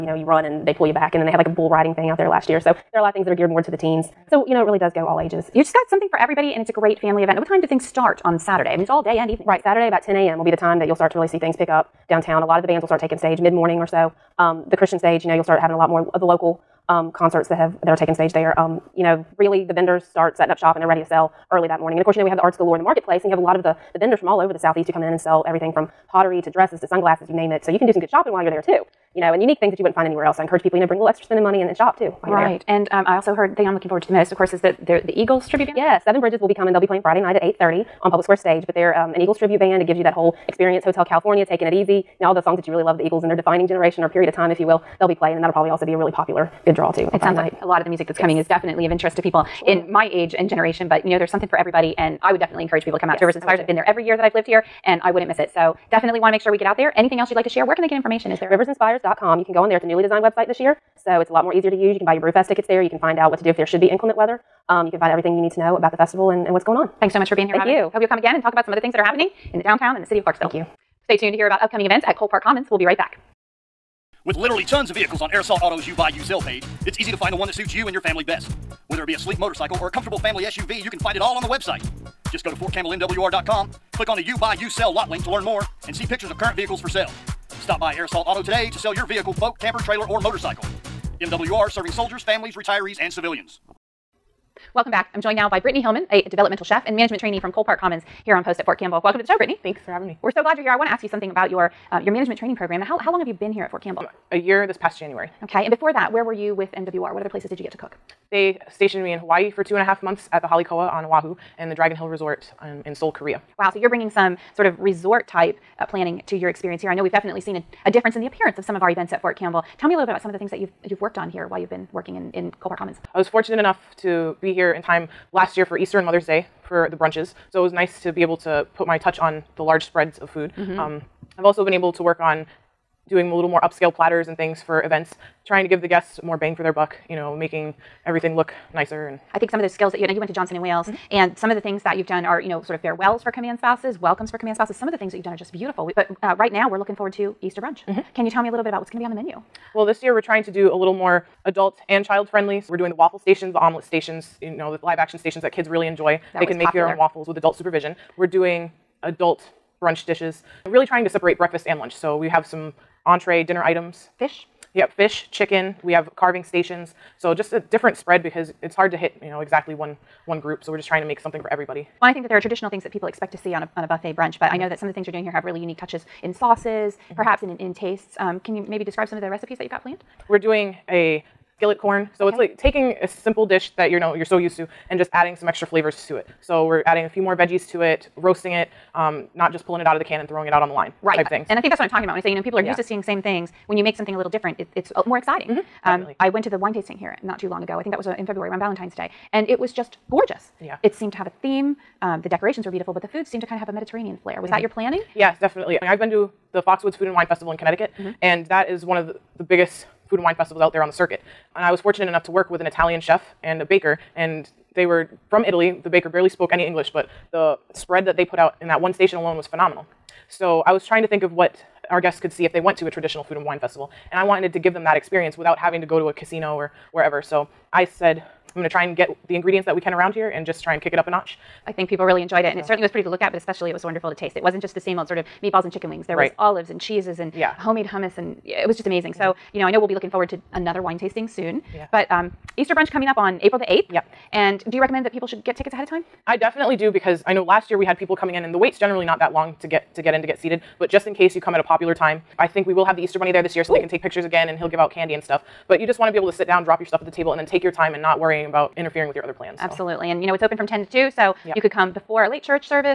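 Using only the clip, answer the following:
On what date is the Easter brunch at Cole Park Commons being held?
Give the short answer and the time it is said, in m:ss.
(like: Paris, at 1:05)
April 8, at 4:03.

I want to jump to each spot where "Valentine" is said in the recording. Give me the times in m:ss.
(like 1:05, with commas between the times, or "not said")
3:18.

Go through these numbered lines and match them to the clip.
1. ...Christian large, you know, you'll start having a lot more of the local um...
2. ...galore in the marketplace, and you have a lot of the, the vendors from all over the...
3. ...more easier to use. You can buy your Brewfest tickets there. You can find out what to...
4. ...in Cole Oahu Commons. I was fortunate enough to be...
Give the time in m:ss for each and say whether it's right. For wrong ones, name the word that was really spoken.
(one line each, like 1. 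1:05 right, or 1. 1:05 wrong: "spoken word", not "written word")
1. 0:14 wrong: "stage", not "large"
2. 0:22 right
3. 1:01 right
4. 2:02 wrong: "Park", not "Oahu".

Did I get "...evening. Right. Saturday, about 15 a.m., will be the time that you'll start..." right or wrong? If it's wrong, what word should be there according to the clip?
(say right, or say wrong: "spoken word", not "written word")
wrong: "10", not "15".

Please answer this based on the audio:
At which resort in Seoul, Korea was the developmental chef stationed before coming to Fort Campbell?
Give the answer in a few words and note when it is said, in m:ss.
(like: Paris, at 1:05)
Dragon Hill Resort, at 1:51.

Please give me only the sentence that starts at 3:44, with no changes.
And I wanted to give them that experience without having to go to a casino or wherever.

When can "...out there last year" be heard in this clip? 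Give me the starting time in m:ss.
0:02.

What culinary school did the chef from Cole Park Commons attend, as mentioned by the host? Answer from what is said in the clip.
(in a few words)
Johnson and Wales.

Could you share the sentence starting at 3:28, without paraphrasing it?
and that is one of the, the biggest food and wine festivals out there on the circuit.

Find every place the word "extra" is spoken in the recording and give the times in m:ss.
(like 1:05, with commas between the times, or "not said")
0:31, 3:05.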